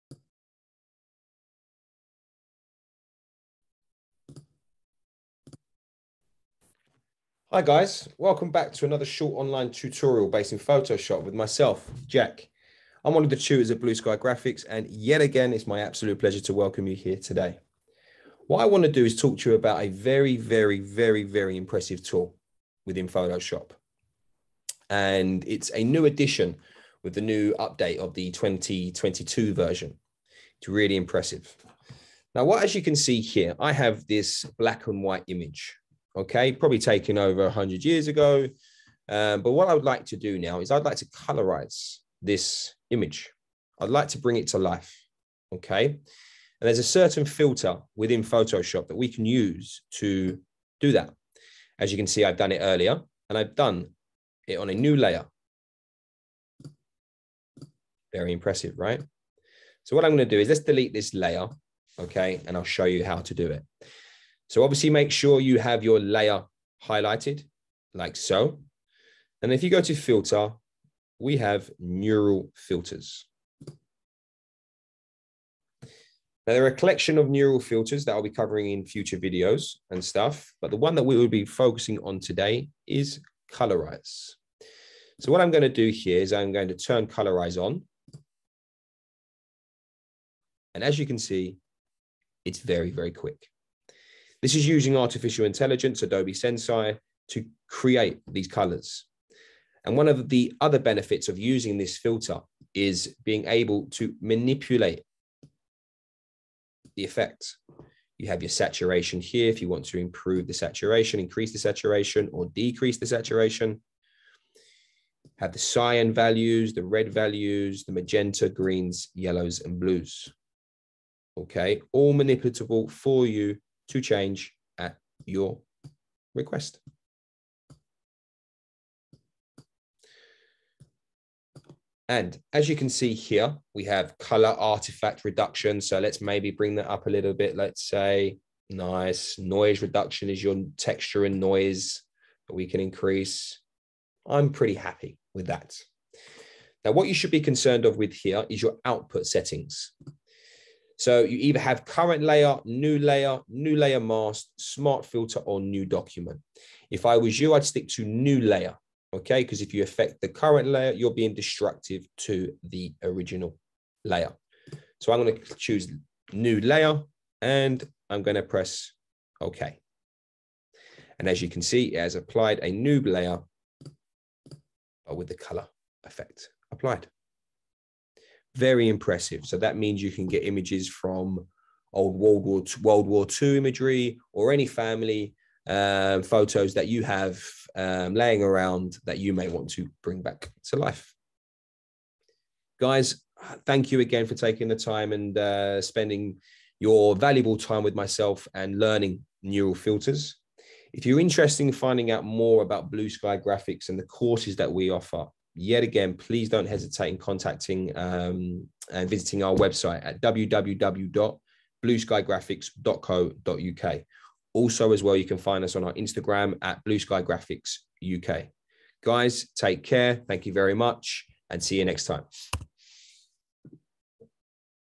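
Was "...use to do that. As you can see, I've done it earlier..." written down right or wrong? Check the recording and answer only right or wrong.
right.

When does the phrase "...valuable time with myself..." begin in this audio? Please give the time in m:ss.
3:17.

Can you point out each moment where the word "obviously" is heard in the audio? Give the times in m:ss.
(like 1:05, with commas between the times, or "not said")
1:04.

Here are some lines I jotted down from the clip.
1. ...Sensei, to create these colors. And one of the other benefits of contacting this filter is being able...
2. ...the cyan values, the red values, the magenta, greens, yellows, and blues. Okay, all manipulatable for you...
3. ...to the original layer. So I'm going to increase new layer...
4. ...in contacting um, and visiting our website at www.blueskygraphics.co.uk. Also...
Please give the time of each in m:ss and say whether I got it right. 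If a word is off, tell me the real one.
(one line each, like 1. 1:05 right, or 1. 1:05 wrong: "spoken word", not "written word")
1. 1:36 wrong: "using", not "contacting"
2. 1:55 right
3. 2:42 wrong: "choose", not "increase"
4. 3:27 right.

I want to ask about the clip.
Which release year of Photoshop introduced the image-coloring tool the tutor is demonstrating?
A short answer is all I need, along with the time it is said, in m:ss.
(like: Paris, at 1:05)
2022, at 0:28.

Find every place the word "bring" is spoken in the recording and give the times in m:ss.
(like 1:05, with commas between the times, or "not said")
0:44, 2:16, 3:10.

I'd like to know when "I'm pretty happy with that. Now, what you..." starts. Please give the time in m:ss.
2:24.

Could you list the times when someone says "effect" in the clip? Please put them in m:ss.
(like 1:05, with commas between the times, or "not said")
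1:47, 2:56.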